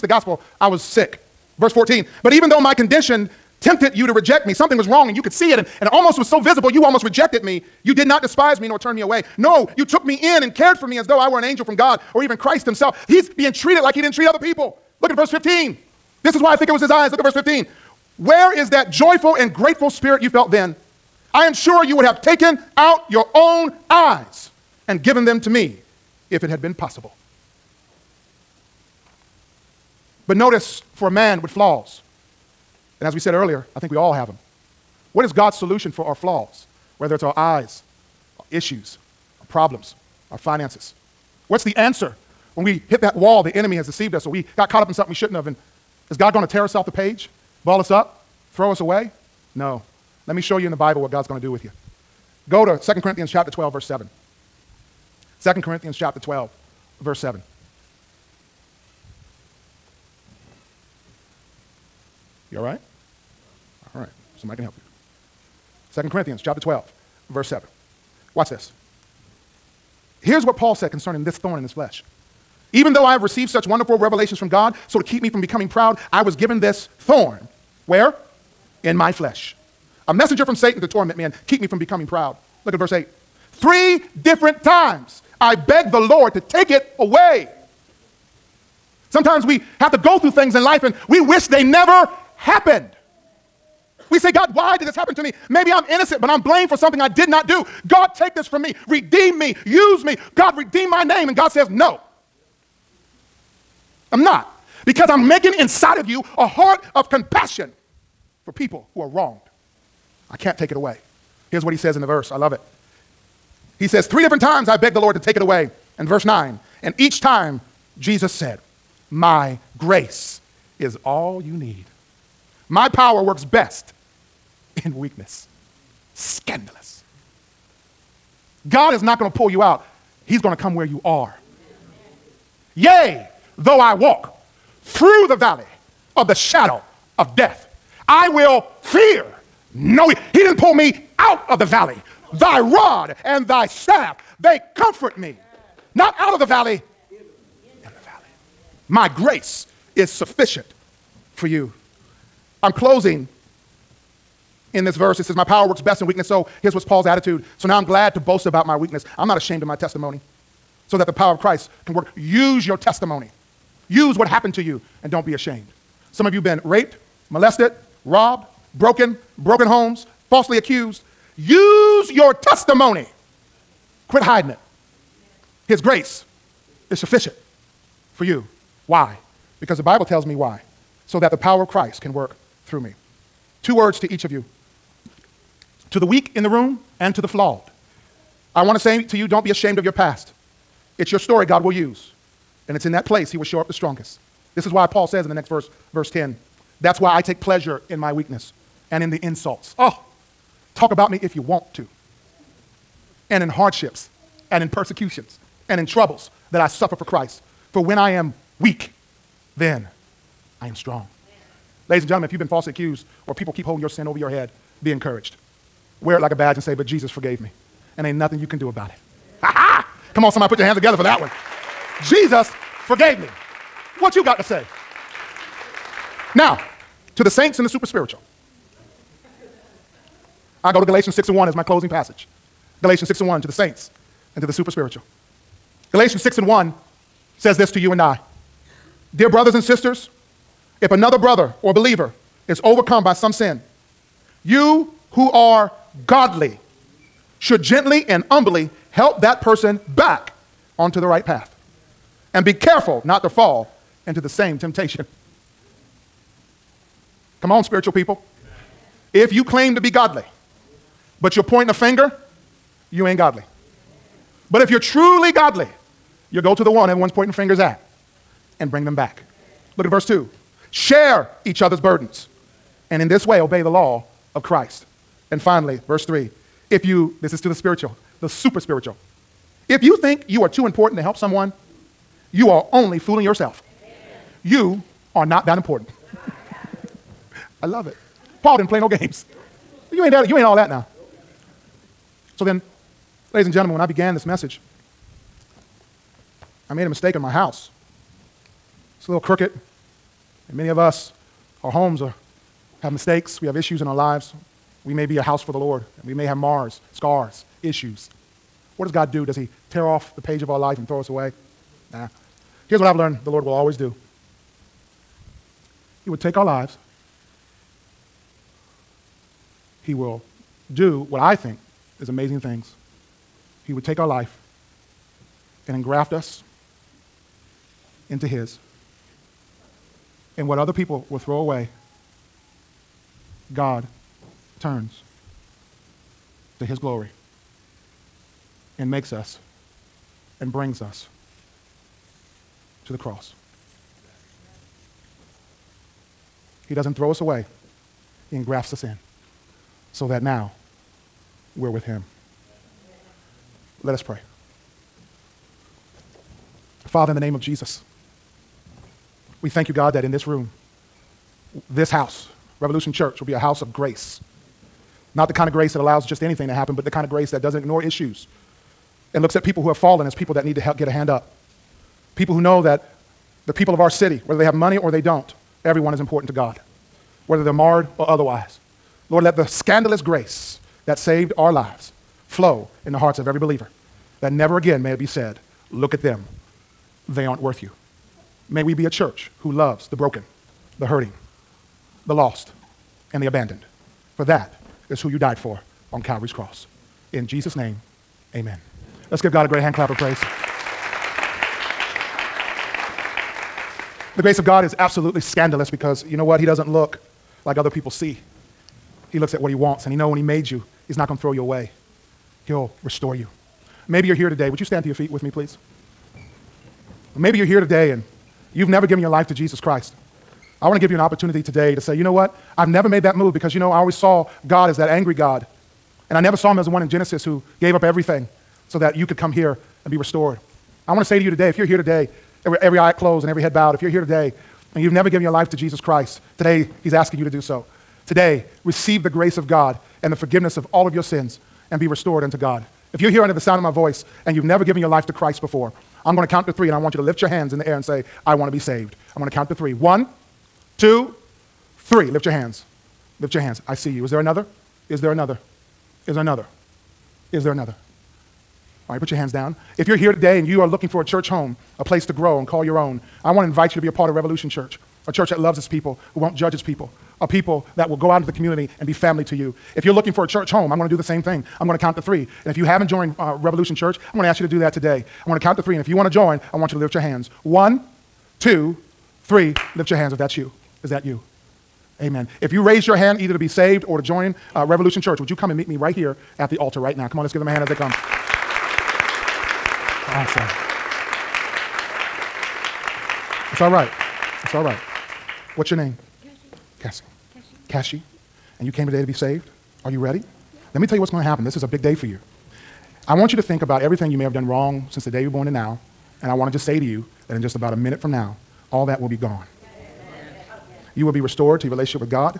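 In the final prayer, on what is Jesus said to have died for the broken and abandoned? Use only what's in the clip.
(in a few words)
Calvary's cross.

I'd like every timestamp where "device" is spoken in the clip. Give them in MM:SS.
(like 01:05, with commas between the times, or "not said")
not said.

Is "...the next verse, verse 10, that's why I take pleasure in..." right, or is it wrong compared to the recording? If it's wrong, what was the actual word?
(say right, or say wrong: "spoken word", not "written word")
right.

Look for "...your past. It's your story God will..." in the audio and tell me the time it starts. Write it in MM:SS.
03:09.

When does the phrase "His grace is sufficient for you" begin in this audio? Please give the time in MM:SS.
02:55.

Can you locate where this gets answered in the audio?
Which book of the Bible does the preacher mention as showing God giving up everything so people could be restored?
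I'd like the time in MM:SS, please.
07:06.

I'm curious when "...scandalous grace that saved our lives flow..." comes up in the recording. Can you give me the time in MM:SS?
06:19.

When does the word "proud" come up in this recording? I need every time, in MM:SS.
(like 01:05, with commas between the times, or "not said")
01:15, 01:22.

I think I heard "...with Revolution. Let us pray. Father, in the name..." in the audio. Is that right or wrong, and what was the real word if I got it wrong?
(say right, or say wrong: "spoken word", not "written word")
wrong: "Him", not "Revolution".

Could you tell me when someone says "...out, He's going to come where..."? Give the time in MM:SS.
02:09.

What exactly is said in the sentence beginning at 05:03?
We have issues in our lives.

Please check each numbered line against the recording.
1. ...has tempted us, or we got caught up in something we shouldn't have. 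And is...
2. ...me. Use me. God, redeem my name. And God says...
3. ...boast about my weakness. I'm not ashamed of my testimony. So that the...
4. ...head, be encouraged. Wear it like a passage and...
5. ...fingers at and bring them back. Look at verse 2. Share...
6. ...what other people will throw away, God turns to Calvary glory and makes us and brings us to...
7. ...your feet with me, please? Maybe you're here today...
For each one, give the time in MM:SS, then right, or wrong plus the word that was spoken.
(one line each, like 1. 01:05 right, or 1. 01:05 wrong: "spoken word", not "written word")
1. 00:43 wrong: "deceived", not "tempted"
2. 01:39 right
3. 02:38 right
4. 03:34 wrong: "badge", not "passage"
5. 04:27 right
6. 05:30 wrong: "His", not "Calvary"
7. 06:54 right.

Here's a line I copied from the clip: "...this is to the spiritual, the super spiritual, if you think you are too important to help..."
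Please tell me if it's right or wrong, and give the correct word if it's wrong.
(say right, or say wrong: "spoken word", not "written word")
right.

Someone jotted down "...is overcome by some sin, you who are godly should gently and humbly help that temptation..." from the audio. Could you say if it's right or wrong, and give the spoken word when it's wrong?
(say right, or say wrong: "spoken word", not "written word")
wrong: "person", not "temptation".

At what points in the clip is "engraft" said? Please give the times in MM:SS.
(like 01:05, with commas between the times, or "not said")
05:25, 05:48.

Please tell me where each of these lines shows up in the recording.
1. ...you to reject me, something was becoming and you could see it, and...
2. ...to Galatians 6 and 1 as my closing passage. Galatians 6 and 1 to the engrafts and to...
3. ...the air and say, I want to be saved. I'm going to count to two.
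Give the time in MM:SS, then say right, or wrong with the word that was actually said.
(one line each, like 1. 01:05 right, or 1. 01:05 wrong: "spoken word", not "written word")
1. 00:03 wrong: "wrong", not "becoming"
2. 03:50 wrong: "saints", not "engrafts"
3. 07:27 wrong: "three", not "two".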